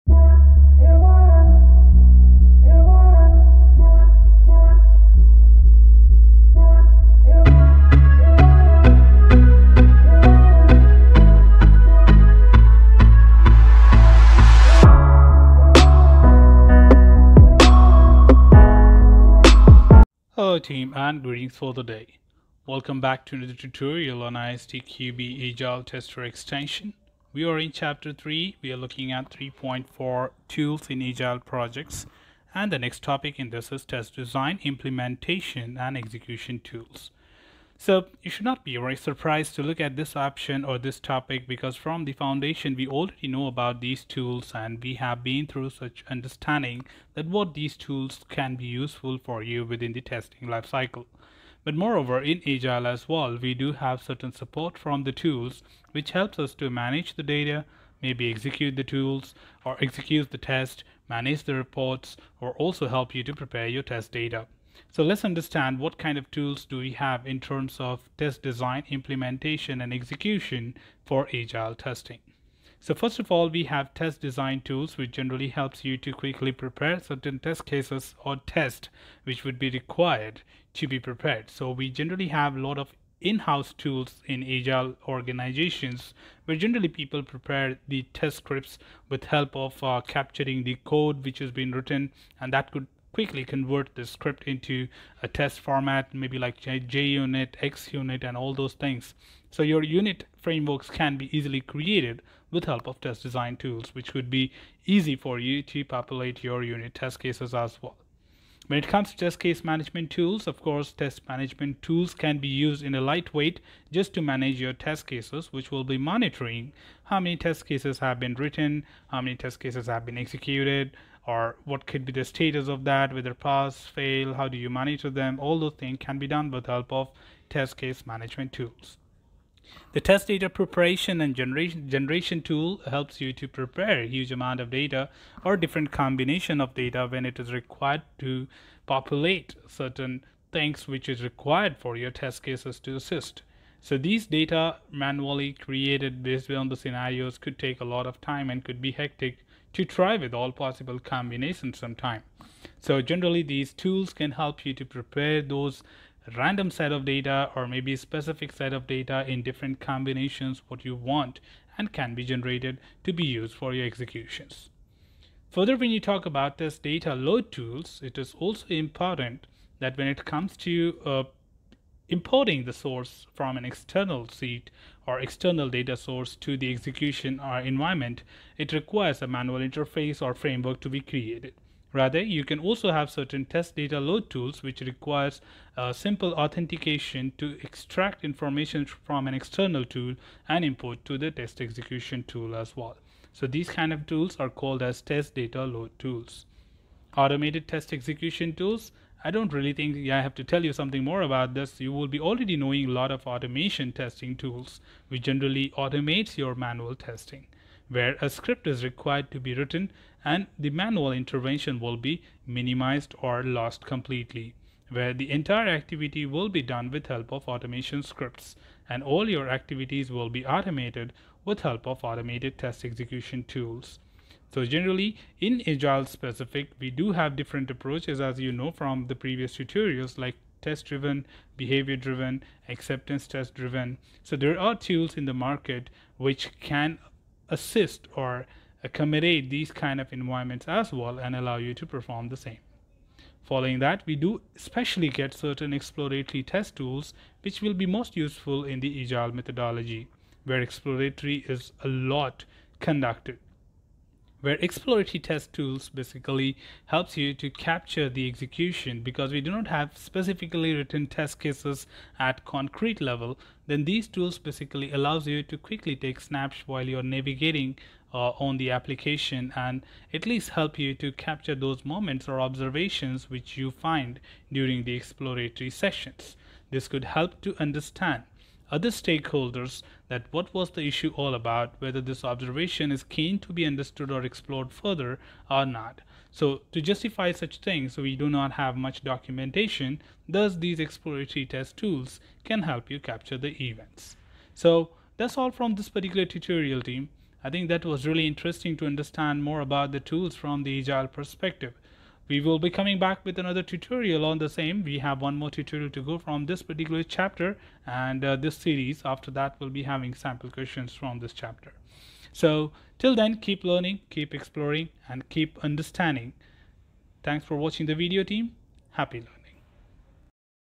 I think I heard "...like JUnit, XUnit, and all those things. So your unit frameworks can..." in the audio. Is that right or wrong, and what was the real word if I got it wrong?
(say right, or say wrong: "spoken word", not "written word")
right.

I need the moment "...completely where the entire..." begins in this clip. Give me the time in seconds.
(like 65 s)
213 s.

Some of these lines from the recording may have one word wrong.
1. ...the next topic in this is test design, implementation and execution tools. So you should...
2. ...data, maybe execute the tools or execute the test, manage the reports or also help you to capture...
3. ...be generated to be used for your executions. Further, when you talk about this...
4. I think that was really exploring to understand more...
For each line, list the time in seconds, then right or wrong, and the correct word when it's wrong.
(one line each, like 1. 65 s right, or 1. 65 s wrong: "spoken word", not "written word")
1. 32 s right
2. 57 s wrong: "prepare", not "capture"
3. 162 s right
4. 297 s wrong: "interesting", not "exploring".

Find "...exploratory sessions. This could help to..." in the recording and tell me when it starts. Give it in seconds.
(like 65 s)
274 s.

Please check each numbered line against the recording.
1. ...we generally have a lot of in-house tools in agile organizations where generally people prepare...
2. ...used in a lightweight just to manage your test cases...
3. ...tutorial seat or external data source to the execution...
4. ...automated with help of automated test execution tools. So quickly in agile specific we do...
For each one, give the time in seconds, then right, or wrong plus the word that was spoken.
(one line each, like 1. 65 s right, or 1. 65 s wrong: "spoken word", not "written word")
1. 81 s right
2. 112 s right
3. 173 s wrong: "external", not "tutorial"
4. 220 s wrong: "generally", not "quickly".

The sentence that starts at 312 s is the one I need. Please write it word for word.
So till then, keep learning, keep exploring and keep understanding.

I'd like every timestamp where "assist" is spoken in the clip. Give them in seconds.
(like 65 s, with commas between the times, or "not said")
142 s, 237 s.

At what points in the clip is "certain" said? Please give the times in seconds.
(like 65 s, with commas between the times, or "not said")
54 s, 77 s, 139 s, 183 s, 245 s.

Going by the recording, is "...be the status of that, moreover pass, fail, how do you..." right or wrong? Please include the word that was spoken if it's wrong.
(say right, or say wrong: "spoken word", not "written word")
wrong: "whether", not "moreover".